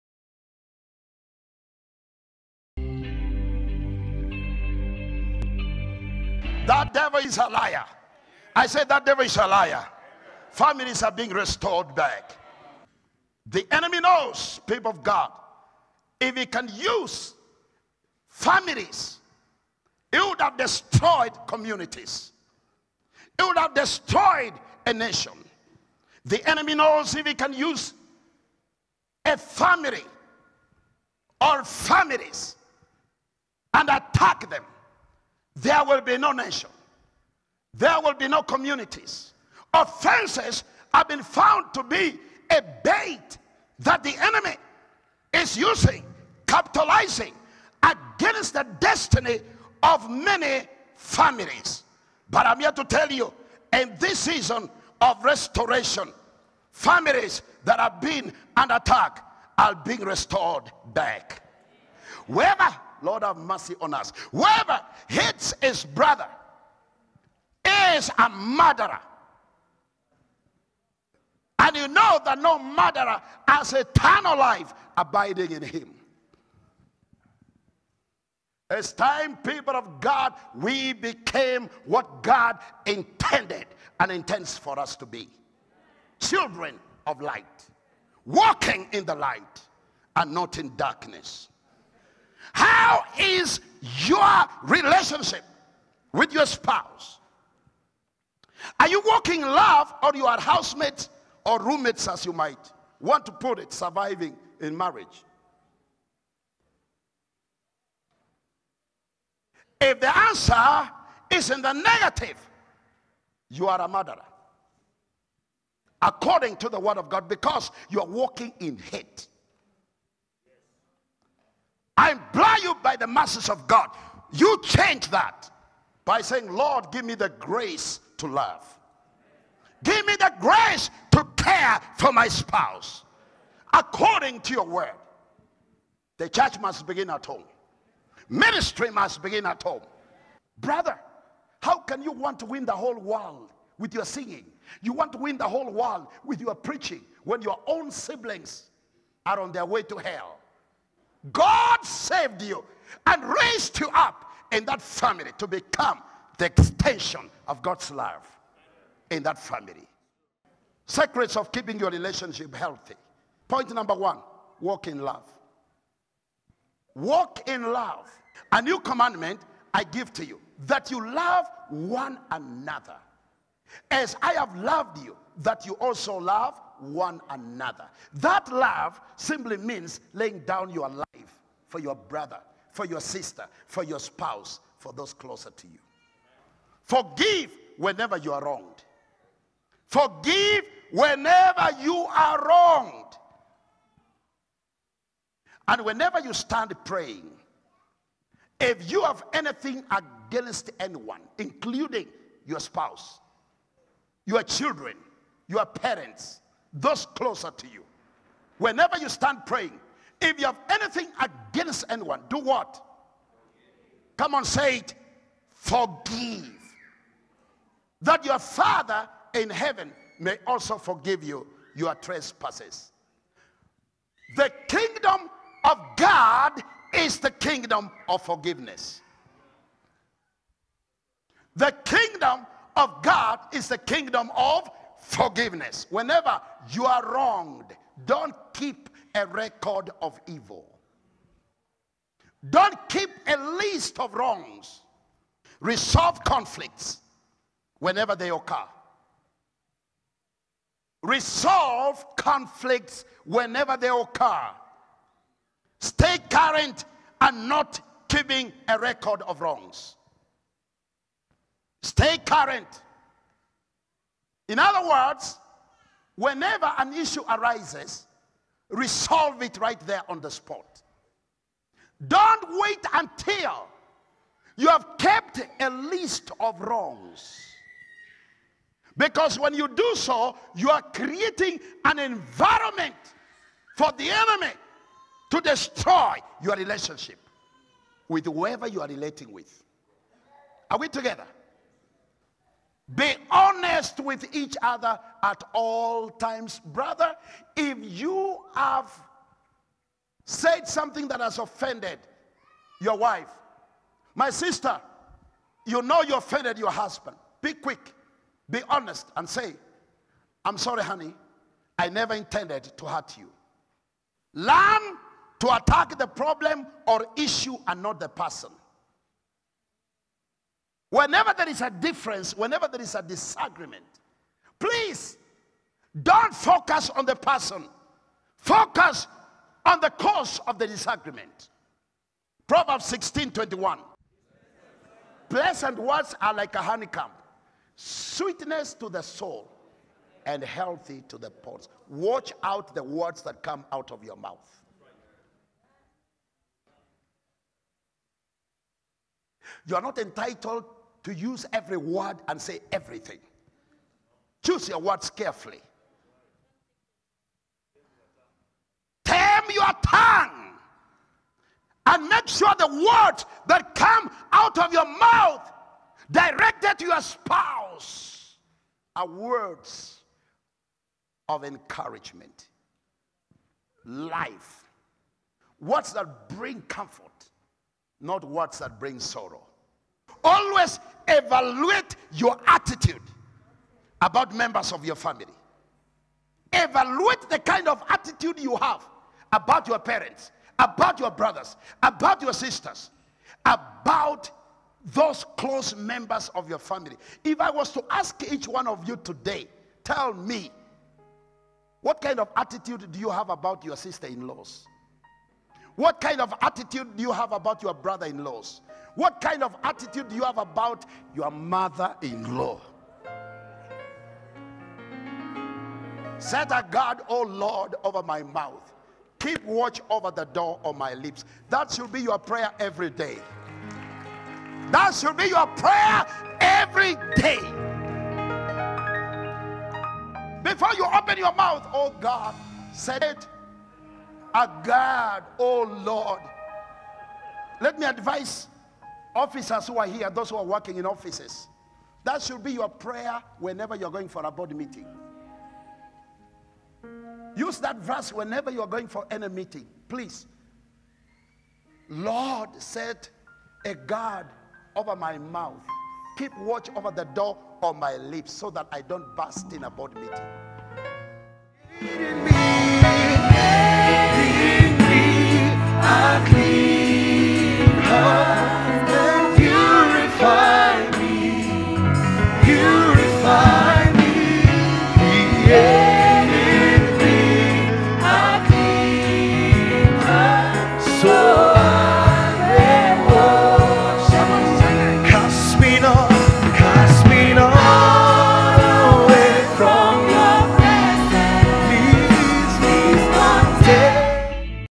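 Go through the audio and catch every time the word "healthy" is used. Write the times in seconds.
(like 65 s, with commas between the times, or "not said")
162 s, 340 s.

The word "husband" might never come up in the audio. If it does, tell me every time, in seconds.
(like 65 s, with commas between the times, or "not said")
306 s.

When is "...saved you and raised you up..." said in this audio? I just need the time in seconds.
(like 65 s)
151 s.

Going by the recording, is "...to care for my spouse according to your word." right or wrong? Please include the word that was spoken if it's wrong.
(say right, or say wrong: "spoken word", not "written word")
right.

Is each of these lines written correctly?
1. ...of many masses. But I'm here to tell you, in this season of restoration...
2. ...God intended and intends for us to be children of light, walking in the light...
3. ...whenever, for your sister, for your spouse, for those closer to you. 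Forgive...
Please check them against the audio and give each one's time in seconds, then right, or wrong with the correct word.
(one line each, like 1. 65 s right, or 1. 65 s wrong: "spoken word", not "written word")
1. 49 s wrong: "families", not "masses"
2. 82 s right
3. 181 s wrong: "brother", not "whenever".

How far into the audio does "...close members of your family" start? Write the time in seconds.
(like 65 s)
395 s.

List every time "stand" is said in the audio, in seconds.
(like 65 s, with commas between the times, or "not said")
196 s, 209 s.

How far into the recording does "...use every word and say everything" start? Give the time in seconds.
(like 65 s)
351 s.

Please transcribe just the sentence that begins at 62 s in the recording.
Wherever Lord, have mercy on us.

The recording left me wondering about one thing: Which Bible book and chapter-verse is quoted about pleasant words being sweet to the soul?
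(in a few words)
Proverbs 16:21.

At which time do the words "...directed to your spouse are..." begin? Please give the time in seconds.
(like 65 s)
366 s.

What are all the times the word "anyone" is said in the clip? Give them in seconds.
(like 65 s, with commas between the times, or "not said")
200 s, 211 s.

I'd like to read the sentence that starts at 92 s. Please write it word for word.
How is your relationship with your spouse?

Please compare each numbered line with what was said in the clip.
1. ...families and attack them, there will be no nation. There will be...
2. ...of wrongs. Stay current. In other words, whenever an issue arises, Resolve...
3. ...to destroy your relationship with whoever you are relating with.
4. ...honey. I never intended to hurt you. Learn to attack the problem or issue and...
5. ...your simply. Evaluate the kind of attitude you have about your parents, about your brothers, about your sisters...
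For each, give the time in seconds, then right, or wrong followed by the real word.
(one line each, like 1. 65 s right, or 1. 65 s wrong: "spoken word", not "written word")
1. 31 s right
2. 259 s right
3. 285 s right
4. 310 s right
5. 384 s wrong: "family", not "simply".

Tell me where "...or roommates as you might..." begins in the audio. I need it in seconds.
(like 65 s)
101 s.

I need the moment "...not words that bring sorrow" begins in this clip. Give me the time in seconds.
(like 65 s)
378 s.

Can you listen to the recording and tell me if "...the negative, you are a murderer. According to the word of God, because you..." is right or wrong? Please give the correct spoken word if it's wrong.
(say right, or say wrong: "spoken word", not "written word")
right.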